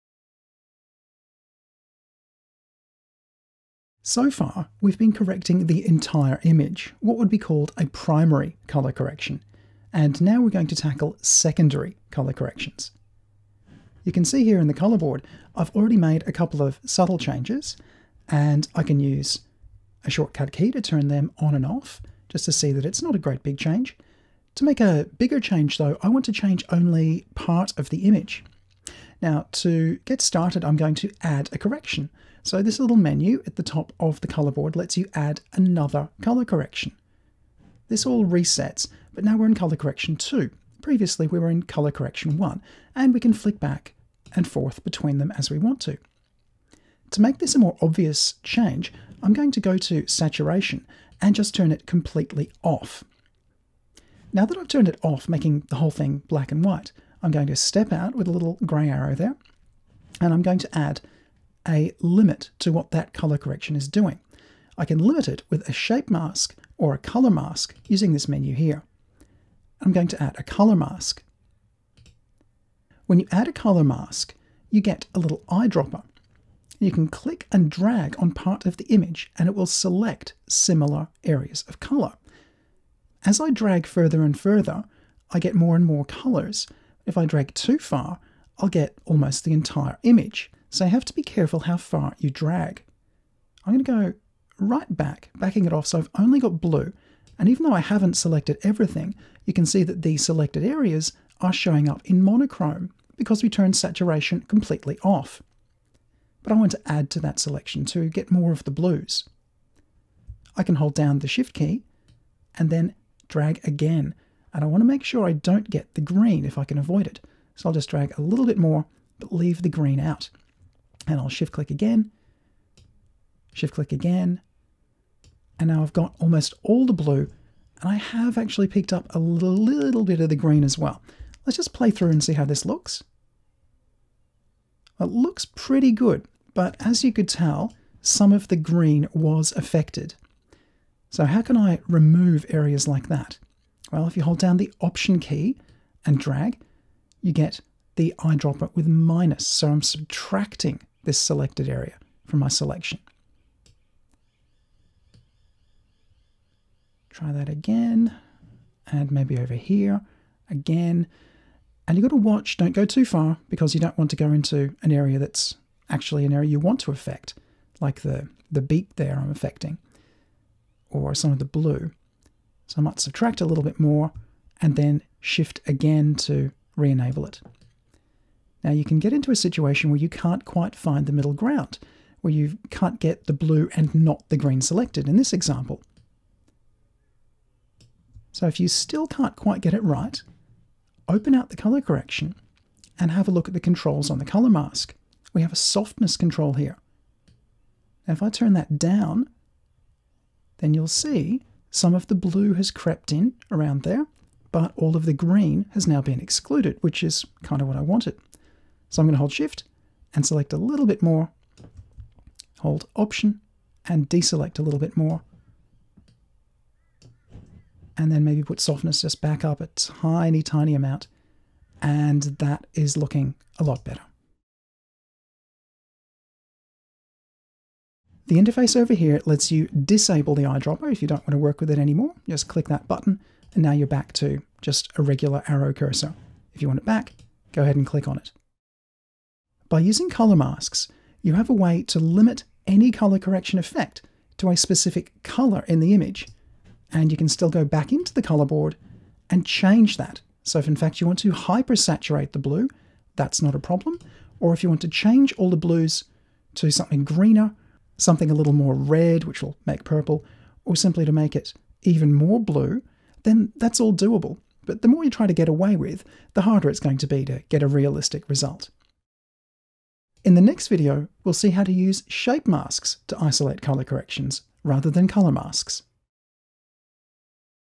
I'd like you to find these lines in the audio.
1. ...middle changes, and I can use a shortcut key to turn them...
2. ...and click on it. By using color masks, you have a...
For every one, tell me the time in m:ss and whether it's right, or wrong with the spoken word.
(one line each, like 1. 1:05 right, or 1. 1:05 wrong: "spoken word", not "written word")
1. 0:16 wrong: "subtle", not "middle"
2. 3:57 right.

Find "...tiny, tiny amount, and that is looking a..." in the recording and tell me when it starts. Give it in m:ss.
3:39.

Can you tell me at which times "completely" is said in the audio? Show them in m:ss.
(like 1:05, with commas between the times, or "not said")
0:51, 1:44.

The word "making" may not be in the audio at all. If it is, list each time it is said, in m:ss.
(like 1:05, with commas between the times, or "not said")
0:55.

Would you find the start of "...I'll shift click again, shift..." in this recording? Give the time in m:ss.
2:01.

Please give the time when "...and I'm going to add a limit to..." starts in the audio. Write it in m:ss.
1:00.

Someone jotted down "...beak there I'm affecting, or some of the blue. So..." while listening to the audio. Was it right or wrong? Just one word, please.
right.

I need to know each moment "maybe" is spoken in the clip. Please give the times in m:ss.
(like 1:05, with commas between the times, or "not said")
2:39, 3:38.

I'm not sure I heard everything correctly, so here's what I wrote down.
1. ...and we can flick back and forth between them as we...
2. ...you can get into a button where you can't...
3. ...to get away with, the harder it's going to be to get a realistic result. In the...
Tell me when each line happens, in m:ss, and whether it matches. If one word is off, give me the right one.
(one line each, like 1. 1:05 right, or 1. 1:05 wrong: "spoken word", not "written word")
1. 0:42 right
2. 2:58 wrong: "situation", not "button"
3. 4:25 right.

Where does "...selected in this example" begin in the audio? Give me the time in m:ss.
3:04.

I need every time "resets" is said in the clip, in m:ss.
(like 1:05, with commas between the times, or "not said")
0:38.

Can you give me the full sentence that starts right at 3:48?
The interface over here lets you disable the eyedropper if you don't want to work with it anymore.